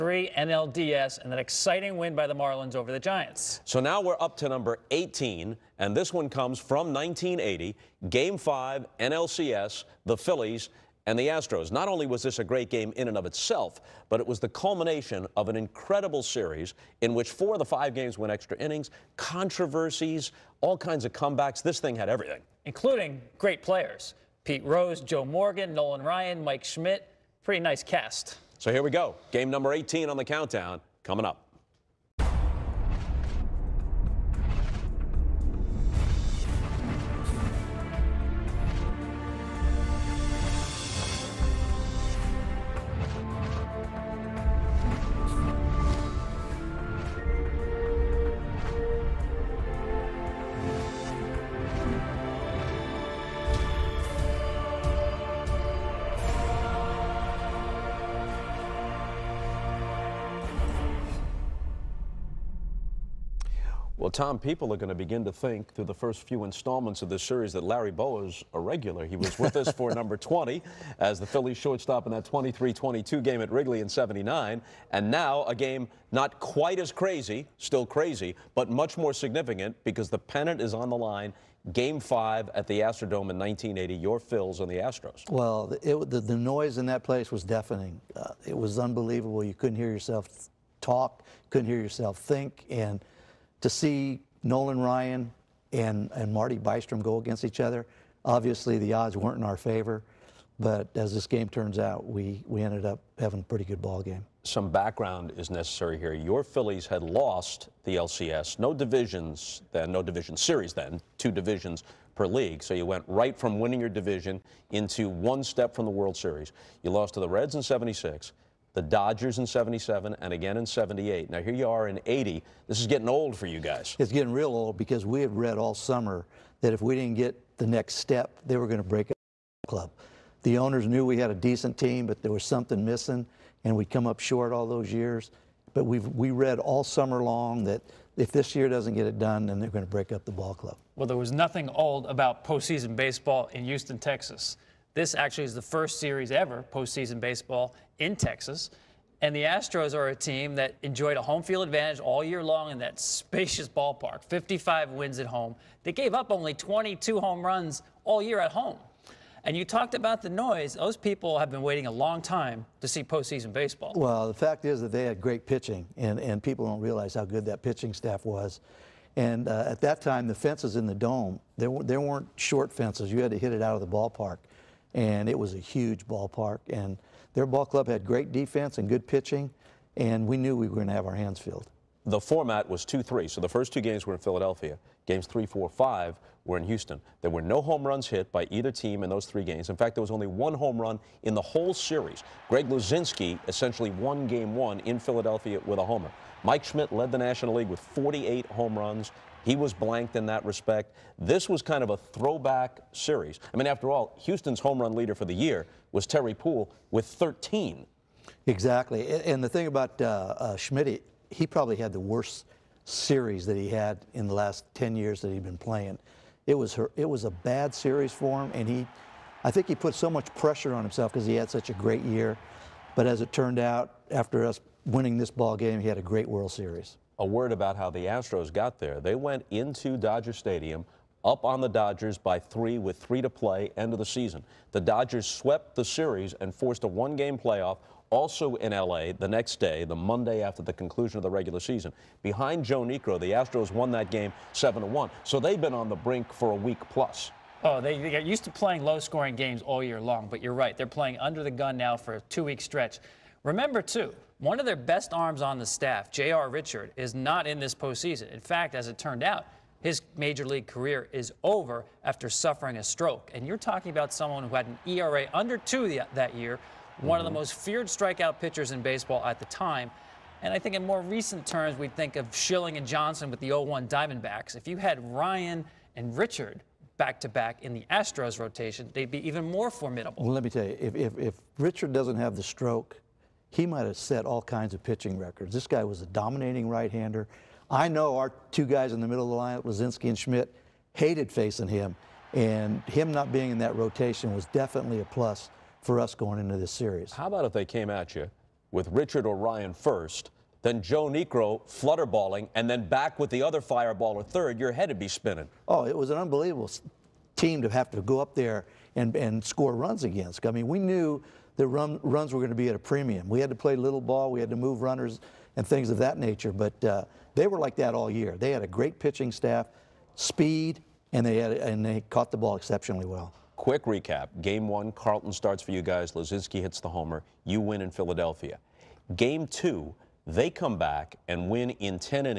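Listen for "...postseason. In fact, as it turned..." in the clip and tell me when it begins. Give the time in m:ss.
4:17.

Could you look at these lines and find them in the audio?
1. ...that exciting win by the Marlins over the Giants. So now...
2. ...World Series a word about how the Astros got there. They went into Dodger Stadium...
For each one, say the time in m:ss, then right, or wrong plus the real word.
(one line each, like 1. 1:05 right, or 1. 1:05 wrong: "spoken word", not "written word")
1. 0:01 right
2. 3:46 right.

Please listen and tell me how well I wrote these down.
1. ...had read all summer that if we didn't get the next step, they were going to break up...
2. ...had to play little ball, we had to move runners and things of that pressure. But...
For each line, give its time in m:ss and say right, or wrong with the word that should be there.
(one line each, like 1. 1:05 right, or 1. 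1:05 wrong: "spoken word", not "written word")
1. 2:05 right
2. 5:13 wrong: "nature", not "pressure".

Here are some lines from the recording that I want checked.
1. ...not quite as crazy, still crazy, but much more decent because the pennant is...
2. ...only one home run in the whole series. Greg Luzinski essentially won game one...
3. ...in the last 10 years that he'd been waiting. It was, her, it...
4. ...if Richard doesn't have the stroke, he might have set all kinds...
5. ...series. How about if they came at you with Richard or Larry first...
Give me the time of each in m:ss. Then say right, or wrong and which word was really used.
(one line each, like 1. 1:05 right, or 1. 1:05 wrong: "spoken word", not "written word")
1. 1:16 wrong: "significant", not "decent"
2. 3:10 right
3. 3:34 wrong: "playing", not "waiting"
4. 4:41 right
5. 4:56 wrong: "Ryan", not "Larry".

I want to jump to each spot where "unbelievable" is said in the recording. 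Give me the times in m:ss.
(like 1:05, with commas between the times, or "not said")
1:28, 5:06.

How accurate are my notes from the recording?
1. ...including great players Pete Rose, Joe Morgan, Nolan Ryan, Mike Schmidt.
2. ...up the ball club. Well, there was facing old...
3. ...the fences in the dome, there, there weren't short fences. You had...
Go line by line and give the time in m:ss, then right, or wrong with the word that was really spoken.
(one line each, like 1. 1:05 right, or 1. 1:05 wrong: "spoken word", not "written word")
1. 0:22 right
2. 2:20 wrong: "nothing", not "facing"
3. 2:50 right.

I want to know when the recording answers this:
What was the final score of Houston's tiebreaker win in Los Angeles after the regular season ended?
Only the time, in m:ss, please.
4:04.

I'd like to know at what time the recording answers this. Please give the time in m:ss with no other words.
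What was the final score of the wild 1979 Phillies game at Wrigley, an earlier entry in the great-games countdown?
1:12.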